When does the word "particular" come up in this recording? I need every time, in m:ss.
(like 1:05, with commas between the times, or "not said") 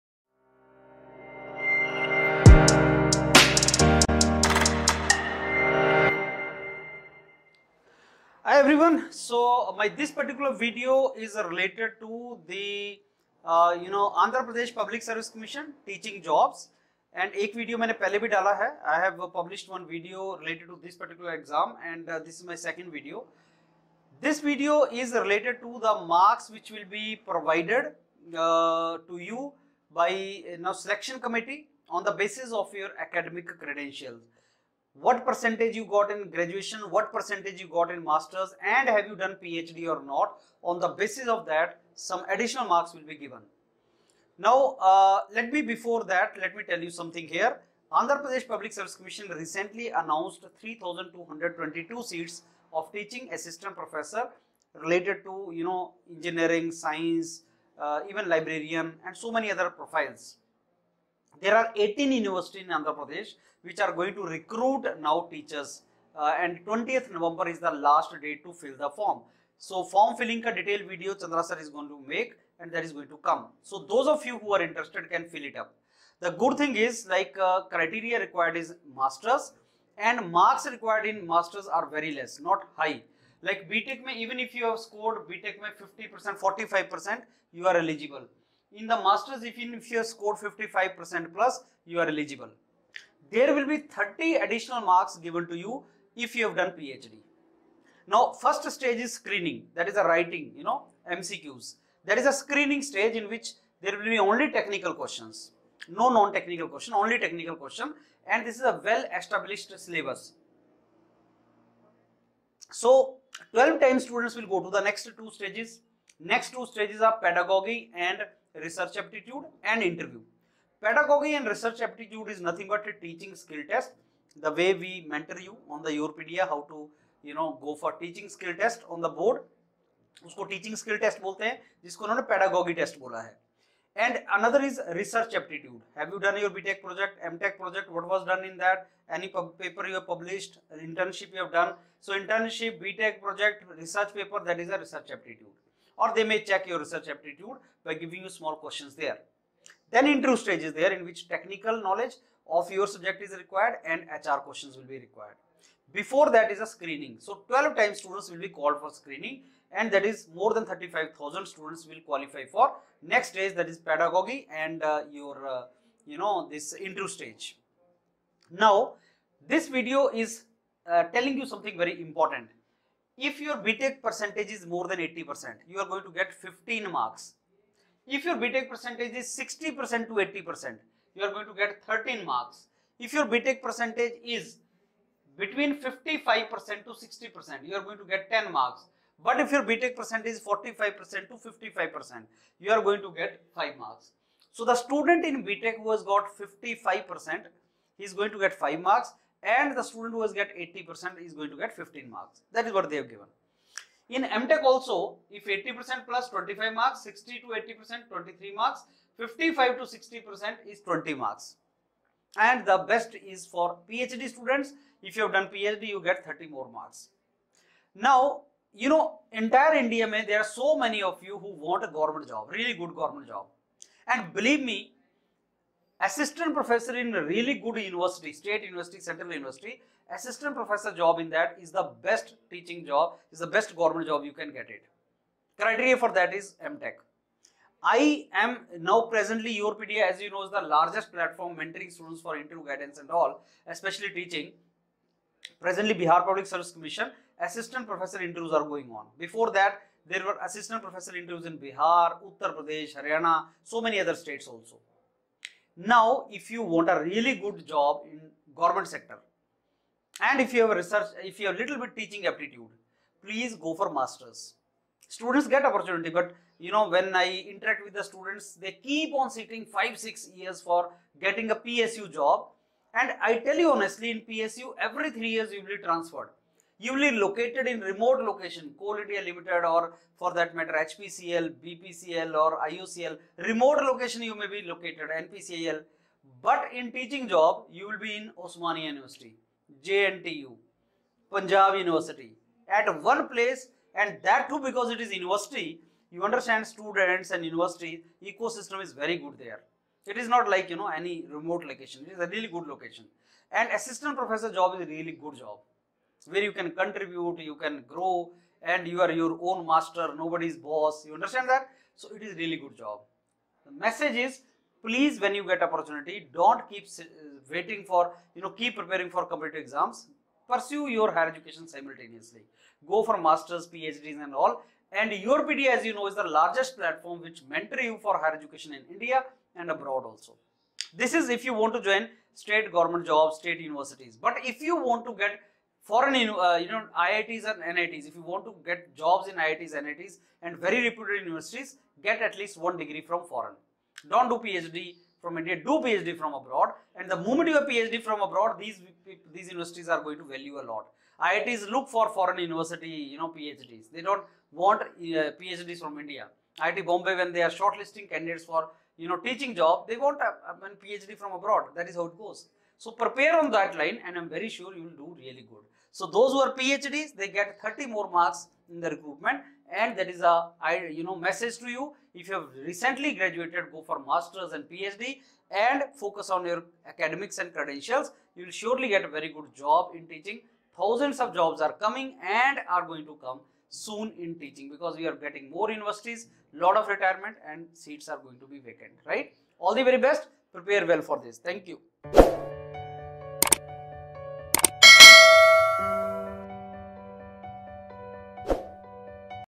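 0:10, 0:20.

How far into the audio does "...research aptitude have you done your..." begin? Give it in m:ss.
2:14.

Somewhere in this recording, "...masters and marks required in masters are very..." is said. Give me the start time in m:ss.
1:18.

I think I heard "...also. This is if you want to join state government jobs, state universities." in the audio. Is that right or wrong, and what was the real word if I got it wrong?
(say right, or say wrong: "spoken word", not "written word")
right.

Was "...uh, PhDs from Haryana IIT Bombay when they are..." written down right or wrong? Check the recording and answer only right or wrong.
wrong.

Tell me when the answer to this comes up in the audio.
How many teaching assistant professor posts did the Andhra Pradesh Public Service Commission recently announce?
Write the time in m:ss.
0:50.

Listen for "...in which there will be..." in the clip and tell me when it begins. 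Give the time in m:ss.
1:43.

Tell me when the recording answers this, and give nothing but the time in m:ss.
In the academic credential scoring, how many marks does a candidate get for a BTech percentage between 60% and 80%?
3:01.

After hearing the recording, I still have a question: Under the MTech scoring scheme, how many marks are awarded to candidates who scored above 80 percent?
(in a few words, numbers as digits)
25.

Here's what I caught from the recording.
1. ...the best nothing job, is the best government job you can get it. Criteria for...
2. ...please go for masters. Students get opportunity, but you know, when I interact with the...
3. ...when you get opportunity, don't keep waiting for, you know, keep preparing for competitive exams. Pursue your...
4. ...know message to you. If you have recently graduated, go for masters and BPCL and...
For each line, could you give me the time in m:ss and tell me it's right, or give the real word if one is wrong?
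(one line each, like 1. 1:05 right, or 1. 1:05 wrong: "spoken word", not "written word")
1. 3:51 wrong: "teaching", not "nothing"
2. 4:23 right
3. 5:15 right
4. 6:11 wrong: "PhD", not "BPCL".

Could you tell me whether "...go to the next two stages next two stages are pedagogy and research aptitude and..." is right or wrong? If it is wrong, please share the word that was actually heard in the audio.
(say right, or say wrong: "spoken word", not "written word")
right.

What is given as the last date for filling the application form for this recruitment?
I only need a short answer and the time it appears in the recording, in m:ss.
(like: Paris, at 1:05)
20th November, at 1:06.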